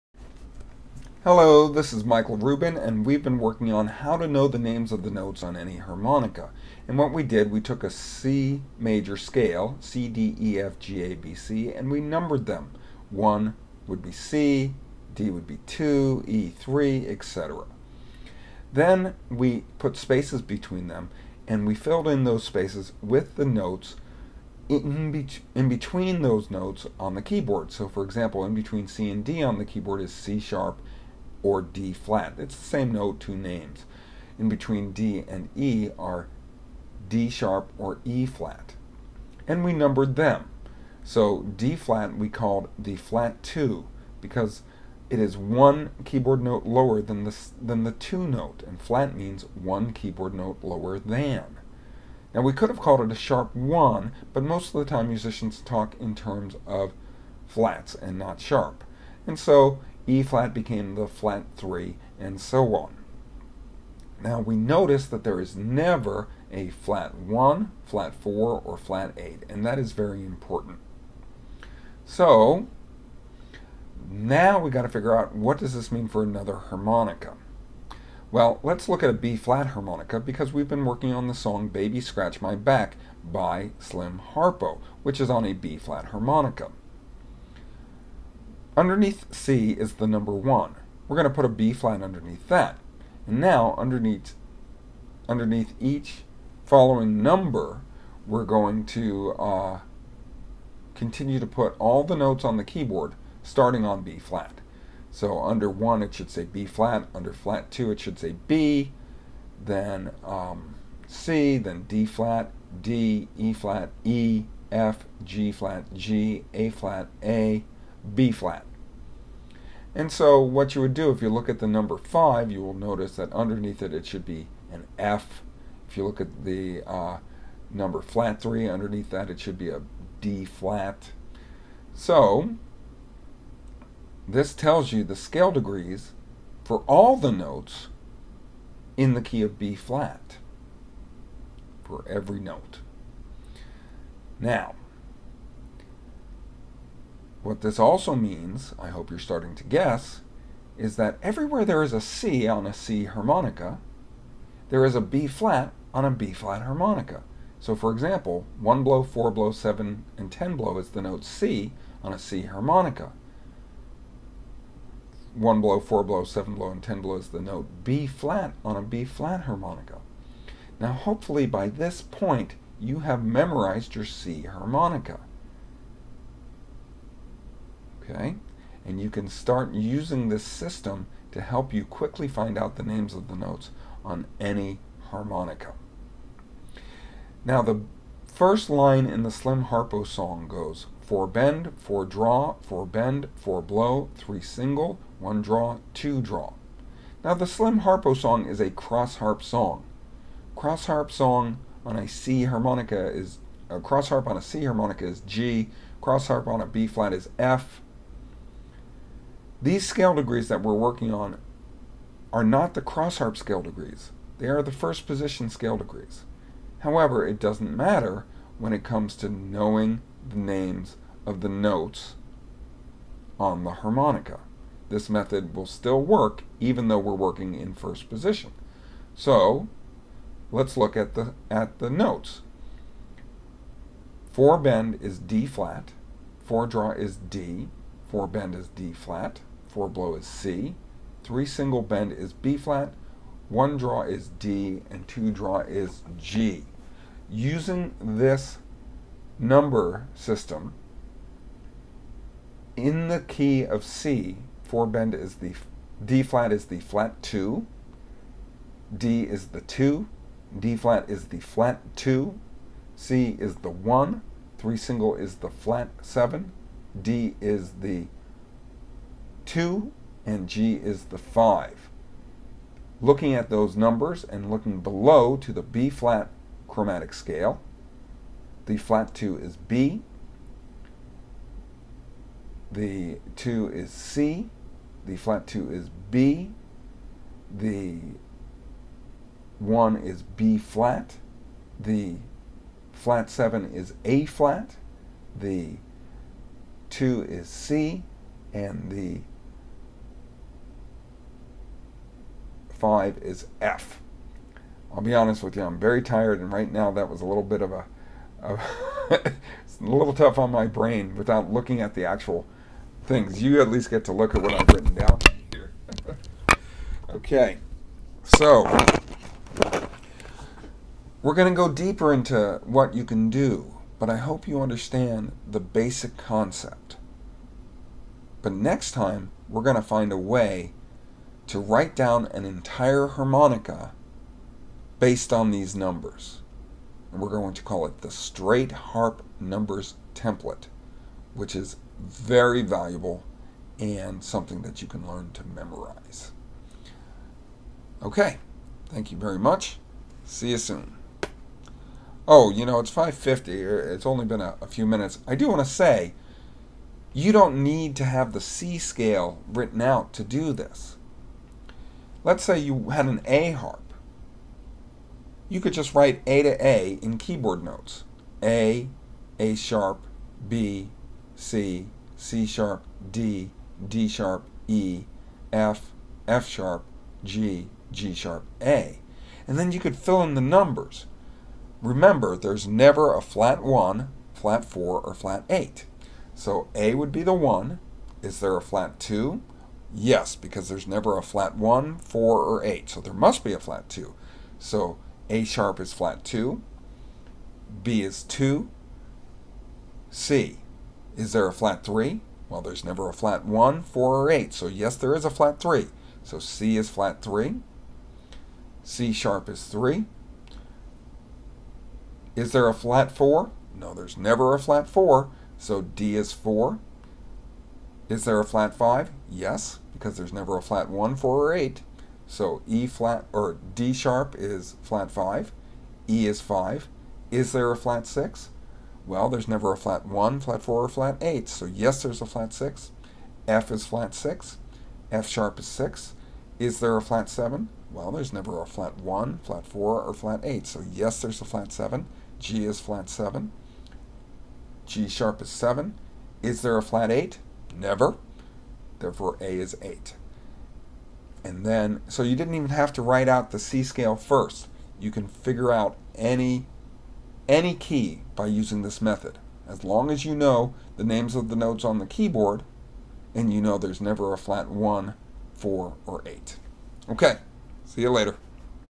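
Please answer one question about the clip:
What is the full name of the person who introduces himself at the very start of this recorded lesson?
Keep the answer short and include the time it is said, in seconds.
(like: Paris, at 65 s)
Michael Rubin, at 2 s.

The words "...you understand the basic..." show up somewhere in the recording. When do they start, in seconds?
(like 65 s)
324 s.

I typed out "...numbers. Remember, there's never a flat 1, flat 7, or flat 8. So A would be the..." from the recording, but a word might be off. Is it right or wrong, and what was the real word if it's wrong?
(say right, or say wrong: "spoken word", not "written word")
wrong: "4", not "7".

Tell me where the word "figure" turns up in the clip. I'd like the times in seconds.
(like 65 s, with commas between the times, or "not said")
74 s, 455 s.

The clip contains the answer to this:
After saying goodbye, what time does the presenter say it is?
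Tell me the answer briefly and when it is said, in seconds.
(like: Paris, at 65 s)
5.50, at 352 s.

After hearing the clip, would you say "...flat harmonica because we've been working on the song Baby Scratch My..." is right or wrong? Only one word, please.
right.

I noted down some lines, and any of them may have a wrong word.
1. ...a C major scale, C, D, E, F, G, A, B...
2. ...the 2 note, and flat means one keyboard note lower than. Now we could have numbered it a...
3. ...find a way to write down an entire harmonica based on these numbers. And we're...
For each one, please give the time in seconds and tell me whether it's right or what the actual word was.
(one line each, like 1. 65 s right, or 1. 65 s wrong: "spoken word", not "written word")
1. 7 s right
2. 47 s wrong: "called", not "numbered"
3. 329 s right.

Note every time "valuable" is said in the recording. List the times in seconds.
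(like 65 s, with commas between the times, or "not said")
342 s.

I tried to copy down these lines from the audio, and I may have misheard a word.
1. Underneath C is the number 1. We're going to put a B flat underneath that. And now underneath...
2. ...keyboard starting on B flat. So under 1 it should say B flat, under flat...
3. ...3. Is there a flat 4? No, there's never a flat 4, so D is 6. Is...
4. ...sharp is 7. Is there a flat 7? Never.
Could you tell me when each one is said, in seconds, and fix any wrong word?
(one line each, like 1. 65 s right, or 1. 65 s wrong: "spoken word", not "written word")
1. 88 s right
2. 102 s right
3. 409 s wrong: "4", not "6"
4. 445 s wrong: "8", not "7".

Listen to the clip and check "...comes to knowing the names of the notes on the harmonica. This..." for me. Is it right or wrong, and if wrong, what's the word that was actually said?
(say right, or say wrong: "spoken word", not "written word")
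right.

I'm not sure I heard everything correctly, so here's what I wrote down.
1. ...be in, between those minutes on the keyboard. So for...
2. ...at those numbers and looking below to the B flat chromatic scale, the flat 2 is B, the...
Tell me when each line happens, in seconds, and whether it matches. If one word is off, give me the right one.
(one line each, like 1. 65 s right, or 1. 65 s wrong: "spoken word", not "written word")
1. 25 s wrong: "notes", not "minutes"
2. 273 s right.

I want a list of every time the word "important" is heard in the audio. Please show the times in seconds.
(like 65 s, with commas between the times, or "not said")
70 s.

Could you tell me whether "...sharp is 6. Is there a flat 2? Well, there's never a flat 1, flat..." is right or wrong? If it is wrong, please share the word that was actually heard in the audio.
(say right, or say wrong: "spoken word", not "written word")
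wrong: "7", not "2".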